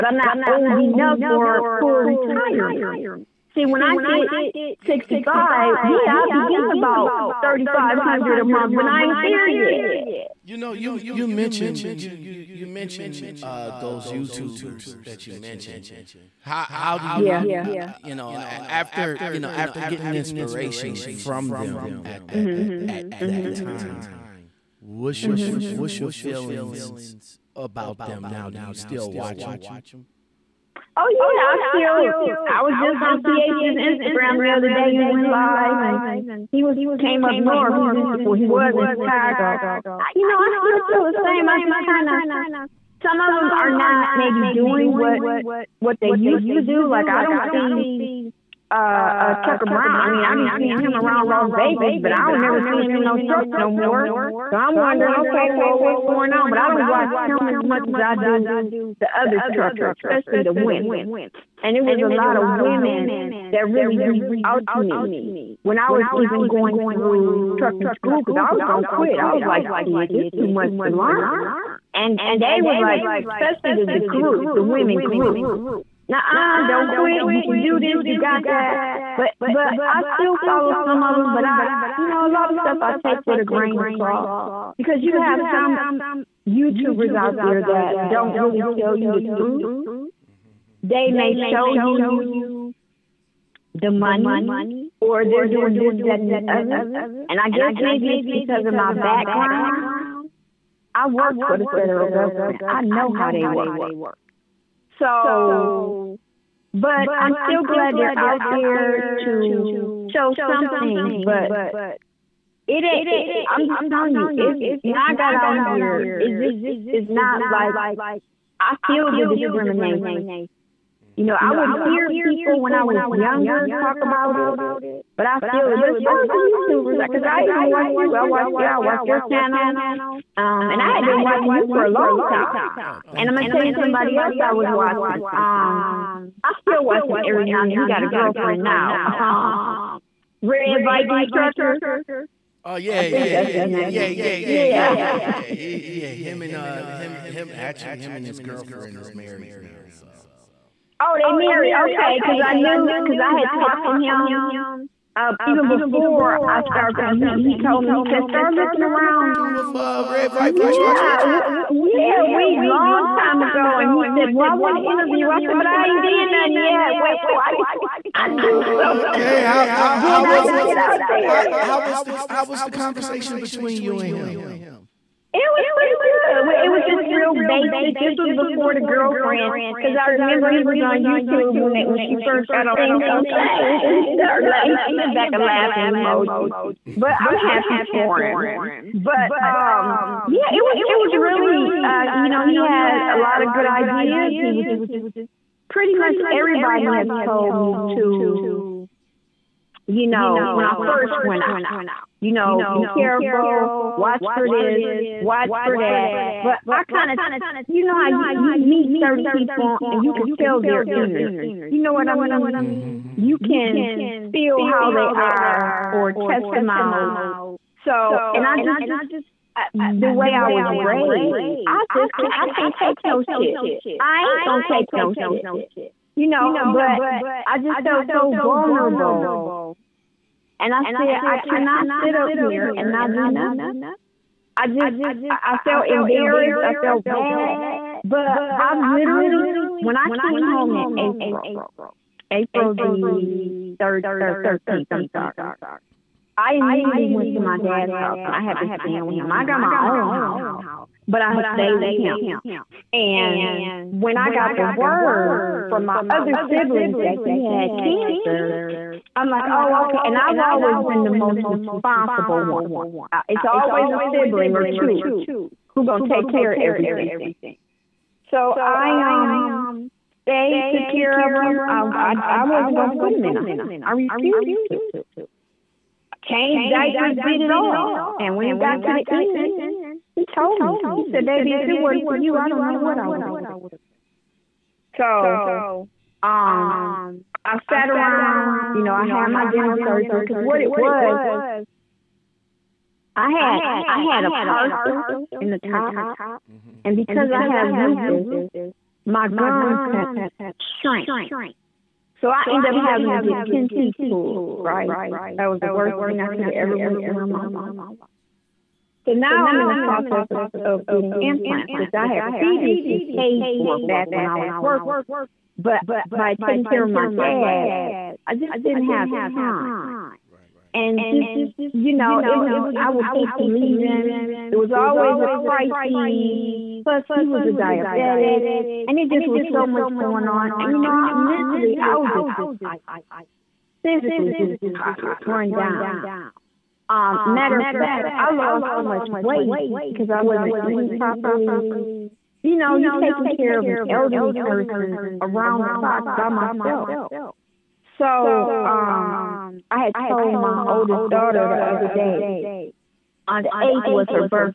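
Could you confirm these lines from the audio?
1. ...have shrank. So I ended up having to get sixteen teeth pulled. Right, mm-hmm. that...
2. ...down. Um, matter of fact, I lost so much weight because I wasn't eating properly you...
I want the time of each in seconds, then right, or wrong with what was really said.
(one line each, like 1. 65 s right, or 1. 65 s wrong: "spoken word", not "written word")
1. 299 s wrong: "ten", not "sixteen"
2. 335 s right.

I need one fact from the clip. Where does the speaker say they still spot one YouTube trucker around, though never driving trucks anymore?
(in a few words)
Las Vegas.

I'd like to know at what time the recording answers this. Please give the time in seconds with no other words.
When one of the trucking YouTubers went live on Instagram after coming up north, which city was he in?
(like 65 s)
38 s.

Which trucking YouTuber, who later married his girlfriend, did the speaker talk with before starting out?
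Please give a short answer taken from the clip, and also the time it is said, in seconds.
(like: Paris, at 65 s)
Red Viking Trucker, at 140 s.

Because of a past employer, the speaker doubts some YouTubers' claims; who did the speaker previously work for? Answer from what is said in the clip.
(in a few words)
The federal government.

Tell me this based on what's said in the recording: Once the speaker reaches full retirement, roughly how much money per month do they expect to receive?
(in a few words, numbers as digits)
3500.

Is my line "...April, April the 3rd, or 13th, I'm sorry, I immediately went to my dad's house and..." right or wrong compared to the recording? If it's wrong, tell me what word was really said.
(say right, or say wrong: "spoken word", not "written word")
right.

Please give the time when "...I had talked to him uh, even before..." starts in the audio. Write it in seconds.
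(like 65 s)
153 s.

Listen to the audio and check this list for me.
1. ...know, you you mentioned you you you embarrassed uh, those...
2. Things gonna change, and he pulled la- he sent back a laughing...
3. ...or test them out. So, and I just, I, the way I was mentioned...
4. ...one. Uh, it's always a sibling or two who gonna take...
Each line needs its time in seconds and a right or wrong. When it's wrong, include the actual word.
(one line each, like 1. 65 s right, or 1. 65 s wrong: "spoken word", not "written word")
1. 10 s wrong: "mentioned", not "embarrassed"
2. 182 s wrong: "started", not "pulled"
3. 215 s wrong: "raised", not "mentioned"
4. 262 s right.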